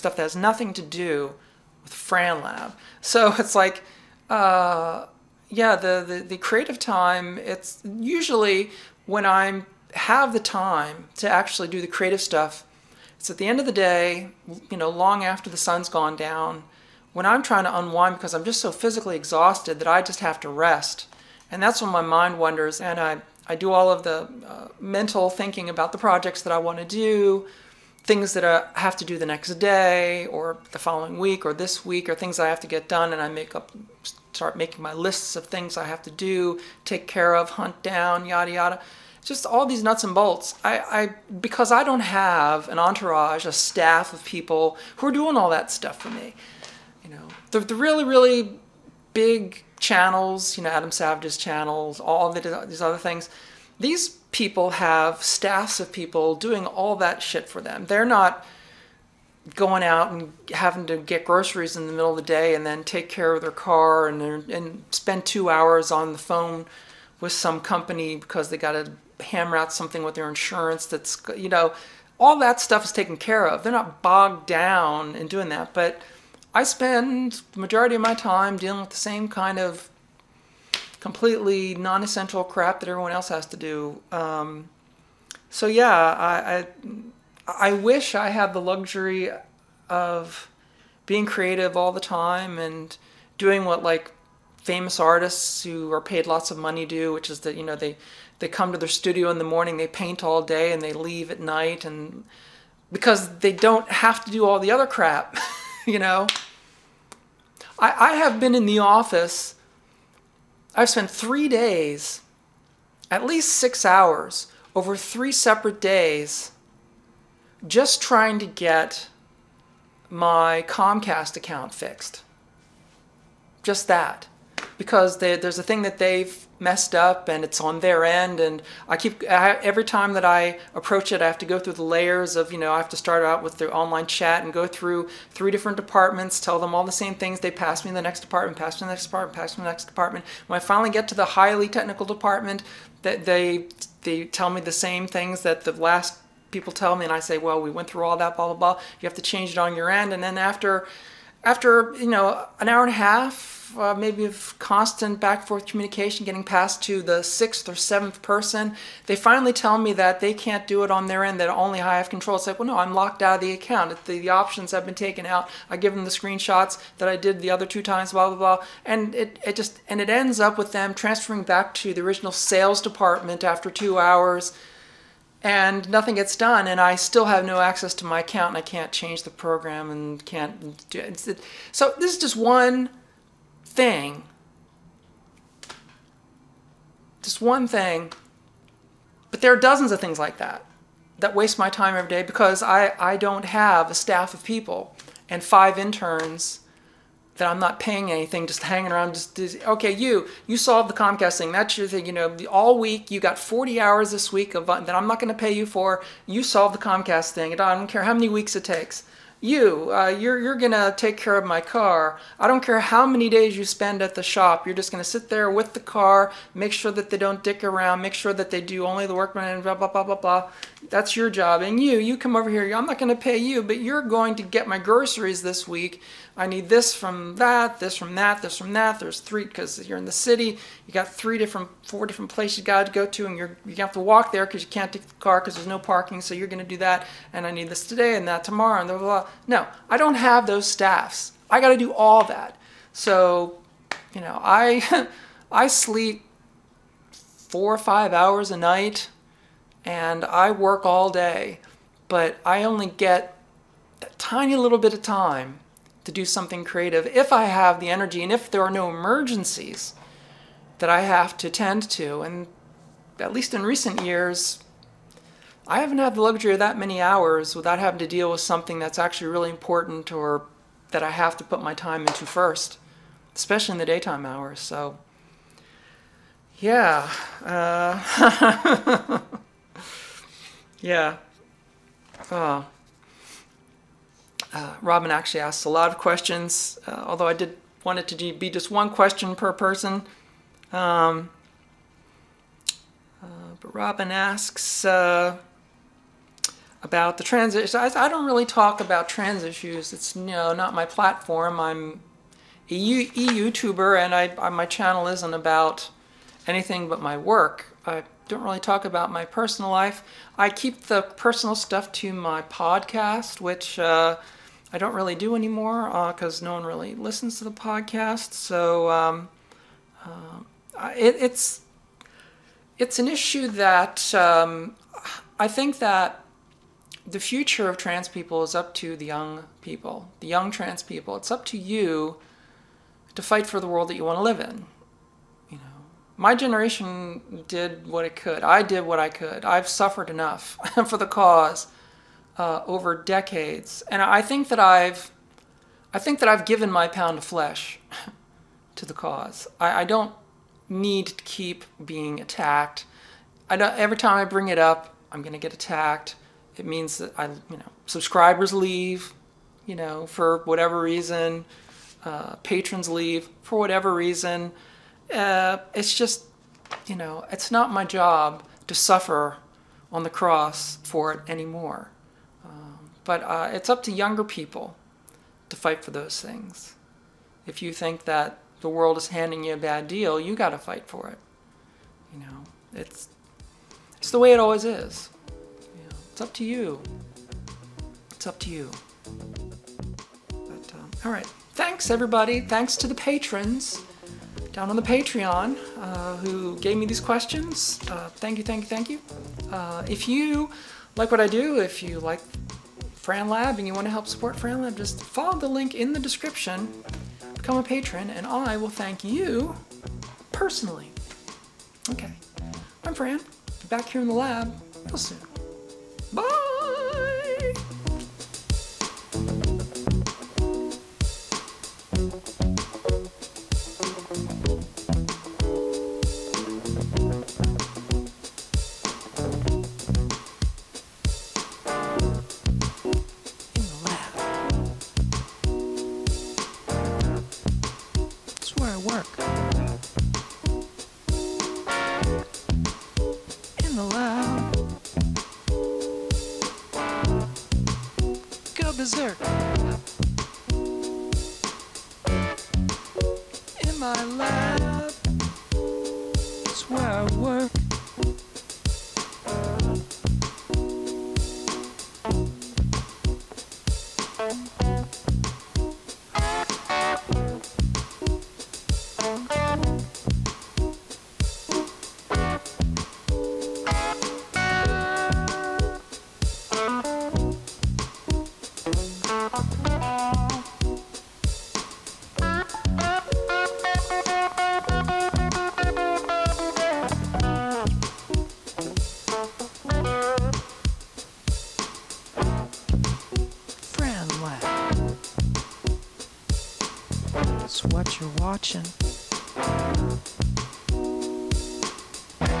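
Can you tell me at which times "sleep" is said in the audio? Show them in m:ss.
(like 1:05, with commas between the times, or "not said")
4:05.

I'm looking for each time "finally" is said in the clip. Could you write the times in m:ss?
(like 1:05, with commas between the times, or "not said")
2:20, 2:39.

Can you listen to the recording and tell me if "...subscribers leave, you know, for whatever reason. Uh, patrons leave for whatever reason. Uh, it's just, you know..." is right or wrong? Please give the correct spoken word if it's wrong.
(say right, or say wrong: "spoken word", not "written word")
right.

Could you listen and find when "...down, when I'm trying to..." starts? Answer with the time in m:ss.
0:16.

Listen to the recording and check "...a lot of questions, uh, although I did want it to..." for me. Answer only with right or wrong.
right.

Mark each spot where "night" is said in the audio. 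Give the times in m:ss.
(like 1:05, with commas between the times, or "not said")
1:41, 4:08.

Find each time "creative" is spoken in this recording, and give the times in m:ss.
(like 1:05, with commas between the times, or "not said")
0:06, 0:11, 1:31, 4:16.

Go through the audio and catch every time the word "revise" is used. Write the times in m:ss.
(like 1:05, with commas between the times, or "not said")
not said.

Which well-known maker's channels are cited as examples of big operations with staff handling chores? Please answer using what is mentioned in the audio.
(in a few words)
Adam Savage.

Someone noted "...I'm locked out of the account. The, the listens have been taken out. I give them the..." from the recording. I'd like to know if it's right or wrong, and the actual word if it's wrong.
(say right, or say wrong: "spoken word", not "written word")
wrong: "options", not "listens".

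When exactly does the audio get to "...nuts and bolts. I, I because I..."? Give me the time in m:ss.
0:39.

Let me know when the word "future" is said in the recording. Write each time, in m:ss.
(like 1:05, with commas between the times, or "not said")
5:27.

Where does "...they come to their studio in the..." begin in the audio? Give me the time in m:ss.
1:38.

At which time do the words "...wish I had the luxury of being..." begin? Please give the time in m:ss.
1:27.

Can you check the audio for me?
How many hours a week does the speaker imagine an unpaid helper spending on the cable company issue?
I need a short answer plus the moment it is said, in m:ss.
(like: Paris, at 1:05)
40, at 3:23.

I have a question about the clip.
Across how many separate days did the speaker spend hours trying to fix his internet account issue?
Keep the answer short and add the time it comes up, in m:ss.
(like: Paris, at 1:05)
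3, at 1:54.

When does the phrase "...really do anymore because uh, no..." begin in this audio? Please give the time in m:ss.
5:14.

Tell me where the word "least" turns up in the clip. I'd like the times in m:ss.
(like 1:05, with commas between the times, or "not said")
1:53, 4:23.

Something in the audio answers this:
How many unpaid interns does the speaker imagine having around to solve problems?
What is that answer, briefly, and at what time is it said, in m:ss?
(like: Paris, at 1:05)
5, at 3:15.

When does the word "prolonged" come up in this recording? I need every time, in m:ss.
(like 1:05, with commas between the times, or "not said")
not said.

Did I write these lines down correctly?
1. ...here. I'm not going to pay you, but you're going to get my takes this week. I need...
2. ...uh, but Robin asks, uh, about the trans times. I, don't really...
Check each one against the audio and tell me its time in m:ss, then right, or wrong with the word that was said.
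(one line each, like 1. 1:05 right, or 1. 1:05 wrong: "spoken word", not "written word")
1. 3:42 wrong: "groceries", not "takes"
2. 4:53 wrong: "issues", not "times".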